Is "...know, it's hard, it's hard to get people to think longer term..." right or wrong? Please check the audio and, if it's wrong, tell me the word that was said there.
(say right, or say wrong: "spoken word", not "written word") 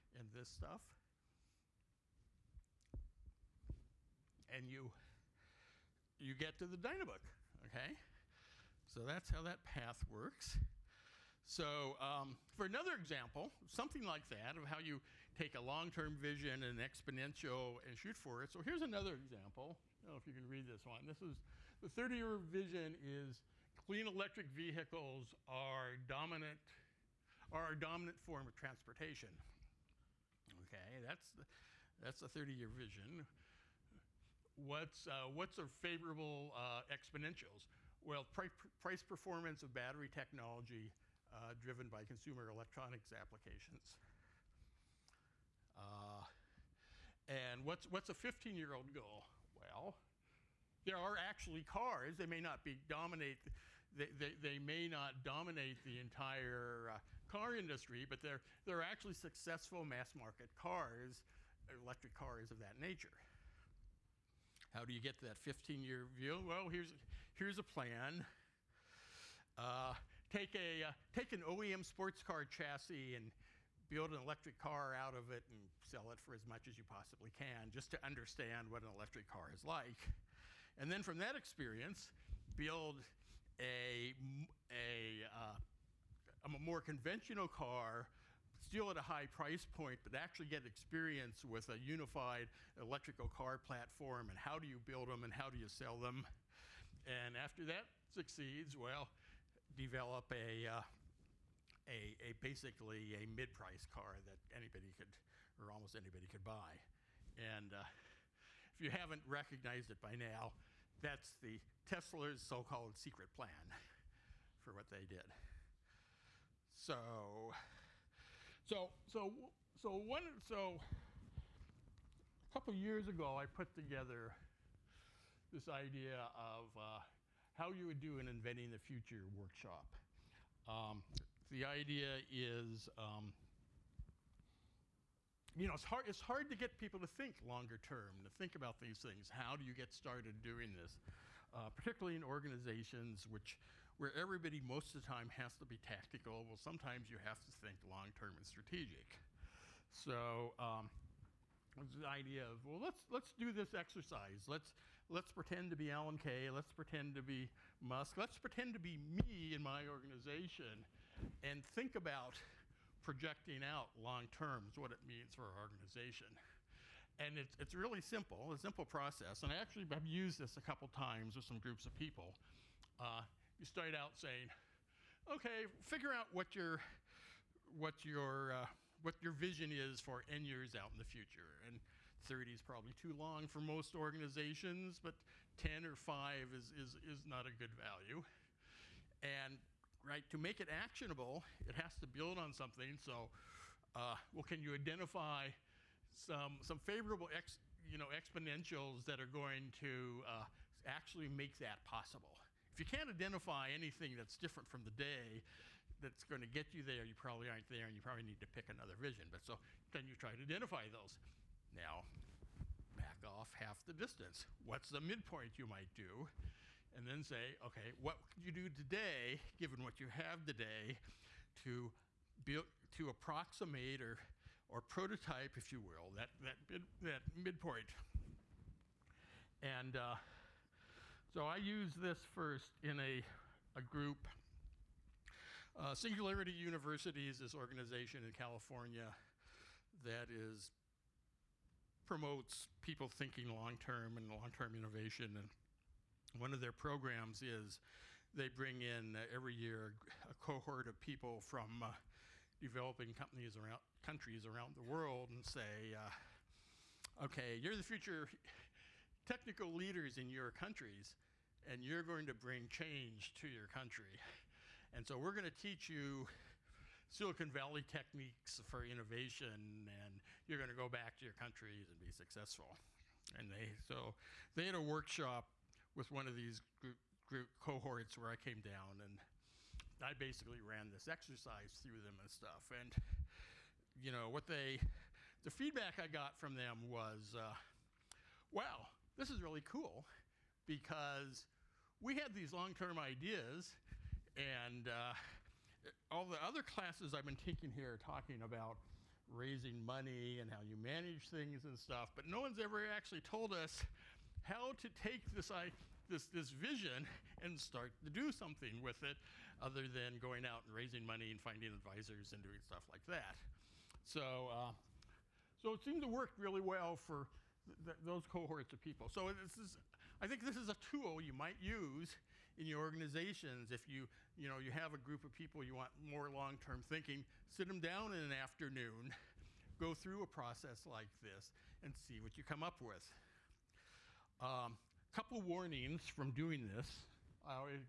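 right.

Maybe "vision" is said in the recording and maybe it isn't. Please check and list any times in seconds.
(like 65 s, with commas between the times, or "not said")
16 s, 22 s, 32 s, 179 s, 208 s, 306 s.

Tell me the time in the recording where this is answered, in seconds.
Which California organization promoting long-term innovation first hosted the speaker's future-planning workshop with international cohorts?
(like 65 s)
235 s.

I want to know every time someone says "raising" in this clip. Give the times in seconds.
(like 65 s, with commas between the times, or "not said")
299 s, 310 s.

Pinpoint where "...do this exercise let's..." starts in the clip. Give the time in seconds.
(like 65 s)
153 s.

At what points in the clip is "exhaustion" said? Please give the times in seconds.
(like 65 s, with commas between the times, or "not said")
not said.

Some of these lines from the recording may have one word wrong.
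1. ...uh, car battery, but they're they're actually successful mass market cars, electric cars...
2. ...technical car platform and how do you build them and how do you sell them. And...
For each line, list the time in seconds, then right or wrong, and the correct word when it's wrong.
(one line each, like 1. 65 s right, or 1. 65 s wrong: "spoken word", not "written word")
1. 56 s wrong: "industry", not "battery"
2. 92 s wrong: "electrical", not "technical".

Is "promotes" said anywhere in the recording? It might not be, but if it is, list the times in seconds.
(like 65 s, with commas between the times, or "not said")
242 s.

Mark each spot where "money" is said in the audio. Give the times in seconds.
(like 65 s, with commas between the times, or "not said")
299 s, 311 s.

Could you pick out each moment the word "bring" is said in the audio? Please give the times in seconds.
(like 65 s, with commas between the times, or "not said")
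248 s, 262 s.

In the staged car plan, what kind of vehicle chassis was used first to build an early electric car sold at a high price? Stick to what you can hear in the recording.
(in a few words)
OEM sports car chassis.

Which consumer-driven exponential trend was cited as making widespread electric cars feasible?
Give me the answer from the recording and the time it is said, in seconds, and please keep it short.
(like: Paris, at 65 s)
Price performance of battery technology, at 38 s.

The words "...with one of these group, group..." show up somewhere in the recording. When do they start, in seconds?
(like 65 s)
275 s.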